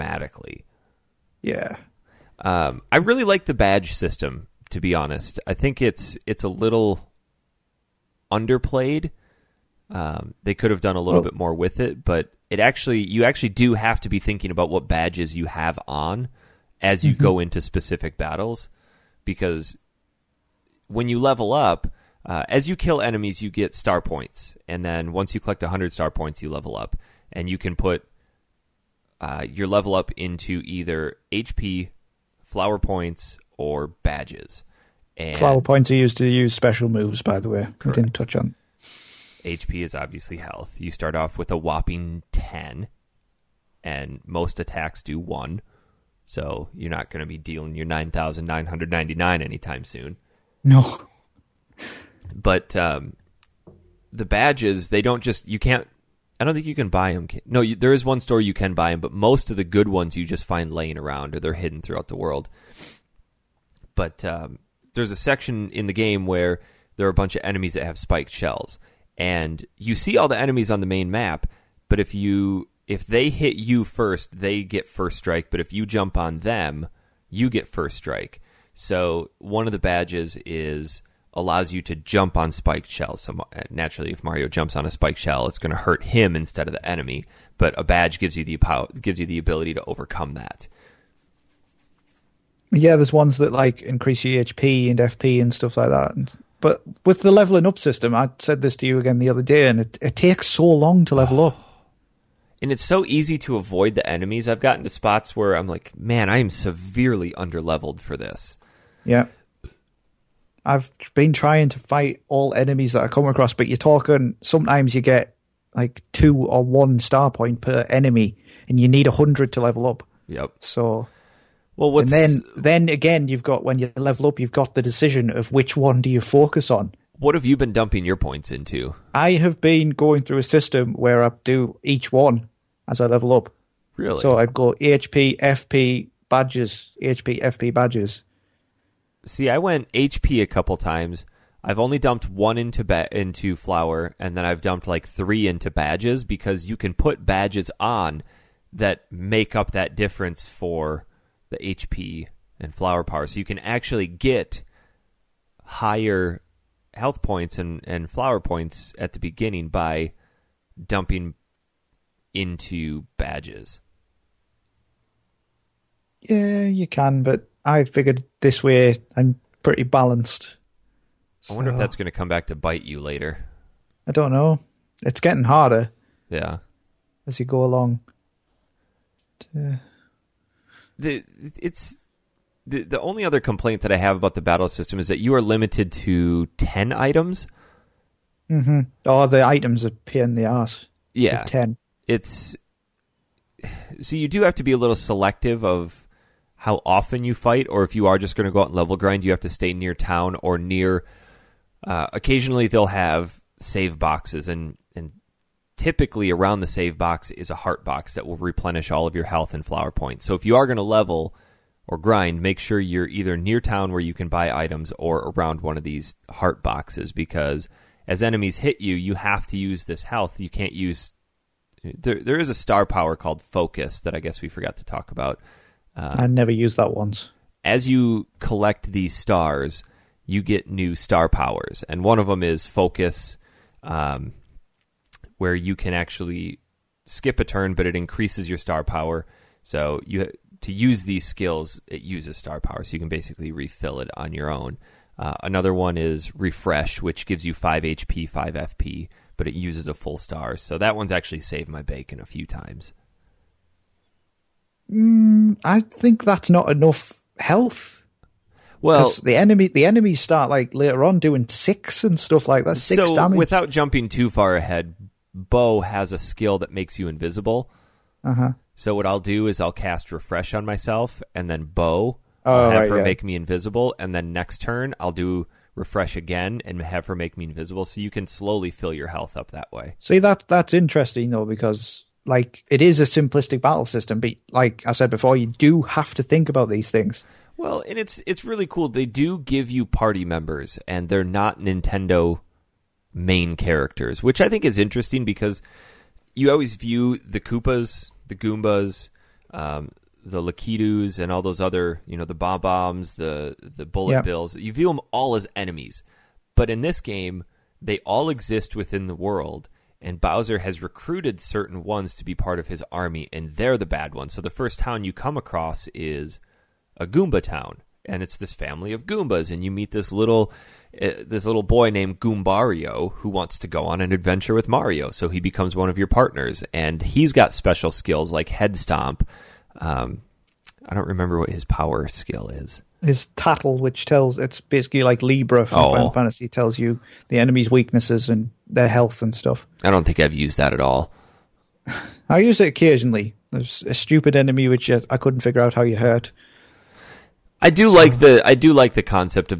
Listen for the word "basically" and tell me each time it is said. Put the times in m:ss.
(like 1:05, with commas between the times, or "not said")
4:03, 5:34.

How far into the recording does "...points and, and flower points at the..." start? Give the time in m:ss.
2:37.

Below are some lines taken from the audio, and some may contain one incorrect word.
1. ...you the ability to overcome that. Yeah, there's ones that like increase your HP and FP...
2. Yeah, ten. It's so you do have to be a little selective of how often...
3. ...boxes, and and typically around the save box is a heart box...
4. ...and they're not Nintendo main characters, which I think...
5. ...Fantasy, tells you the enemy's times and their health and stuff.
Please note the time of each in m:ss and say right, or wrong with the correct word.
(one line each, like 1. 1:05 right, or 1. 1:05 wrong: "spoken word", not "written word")
1. 1:29 right
2. 3:11 right
3. 3:23 right
4. 4:50 right
5. 5:36 wrong: "weaknesses", not "times".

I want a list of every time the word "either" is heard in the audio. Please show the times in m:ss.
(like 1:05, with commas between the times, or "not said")
0:30, 3:33.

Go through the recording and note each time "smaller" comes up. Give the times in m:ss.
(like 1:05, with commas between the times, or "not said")
not said.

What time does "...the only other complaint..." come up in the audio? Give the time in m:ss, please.
3:02.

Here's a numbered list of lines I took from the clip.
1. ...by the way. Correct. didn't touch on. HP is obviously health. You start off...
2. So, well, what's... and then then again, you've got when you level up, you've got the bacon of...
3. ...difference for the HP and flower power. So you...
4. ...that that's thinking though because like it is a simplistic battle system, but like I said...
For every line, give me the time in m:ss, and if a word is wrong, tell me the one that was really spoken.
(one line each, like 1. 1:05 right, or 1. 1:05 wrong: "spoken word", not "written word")
1. 0:37 right
2. 2:00 wrong: "decision", not "bacon"
3. 2:29 right
4. 4:40 wrong: "interesting", not "thinking".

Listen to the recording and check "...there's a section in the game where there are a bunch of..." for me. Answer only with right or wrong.
right.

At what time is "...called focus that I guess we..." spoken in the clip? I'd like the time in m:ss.
3:43.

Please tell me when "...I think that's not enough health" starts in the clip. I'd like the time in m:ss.
4:15.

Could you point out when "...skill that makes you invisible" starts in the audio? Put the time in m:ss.
4:26.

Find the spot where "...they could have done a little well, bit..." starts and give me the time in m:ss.
0:10.